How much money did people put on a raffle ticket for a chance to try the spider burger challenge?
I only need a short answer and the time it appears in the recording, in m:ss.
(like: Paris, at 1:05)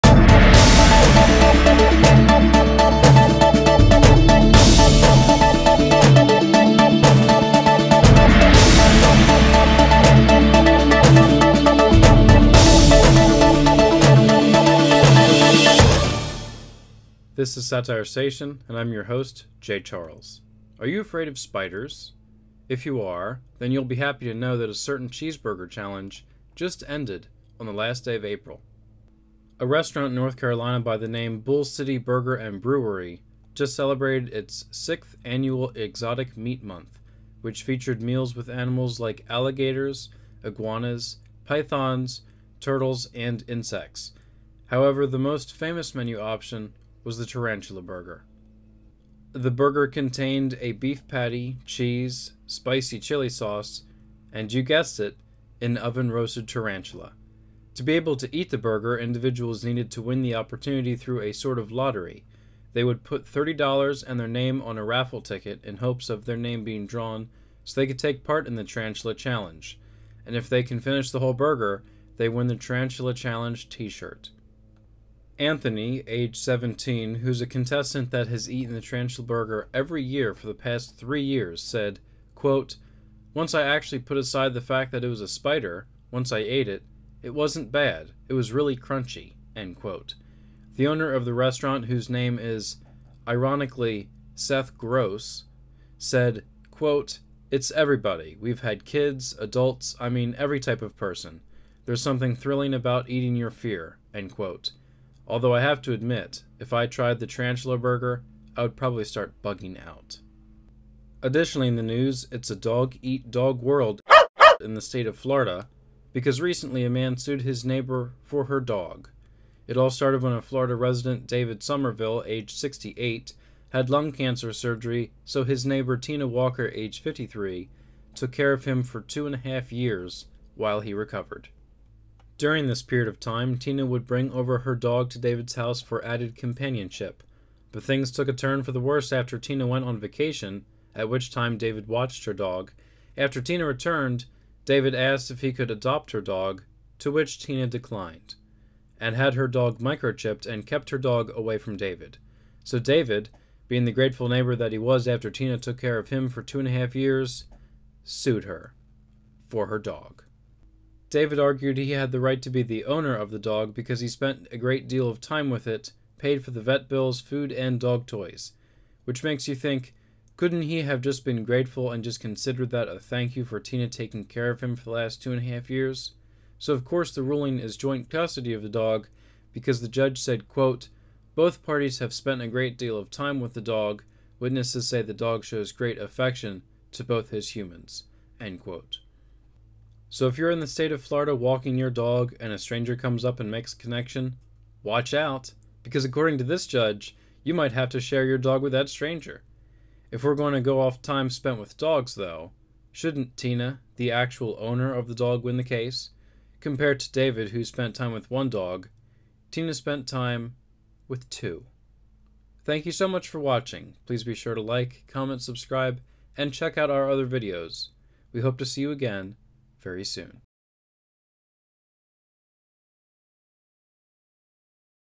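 $30, at 1:03.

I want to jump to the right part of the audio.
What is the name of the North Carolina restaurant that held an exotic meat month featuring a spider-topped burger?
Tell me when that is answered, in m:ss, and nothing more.
0:31.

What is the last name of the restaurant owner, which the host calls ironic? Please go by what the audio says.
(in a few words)
Gross.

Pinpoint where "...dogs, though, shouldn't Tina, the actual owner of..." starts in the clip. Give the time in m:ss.
3:21.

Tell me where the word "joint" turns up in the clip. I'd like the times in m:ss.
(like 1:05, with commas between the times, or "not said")
2:57.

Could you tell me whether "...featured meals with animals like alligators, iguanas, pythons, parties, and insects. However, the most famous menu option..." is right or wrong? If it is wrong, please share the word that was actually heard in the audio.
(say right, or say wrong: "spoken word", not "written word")
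wrong: "turtles", not "parties".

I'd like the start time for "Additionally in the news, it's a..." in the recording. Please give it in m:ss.
1:51.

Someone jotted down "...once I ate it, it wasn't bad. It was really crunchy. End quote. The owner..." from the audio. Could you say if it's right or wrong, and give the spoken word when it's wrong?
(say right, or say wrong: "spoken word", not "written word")
right.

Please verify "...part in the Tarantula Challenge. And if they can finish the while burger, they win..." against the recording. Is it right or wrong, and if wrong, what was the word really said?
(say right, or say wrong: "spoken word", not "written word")
wrong: "whole", not "while".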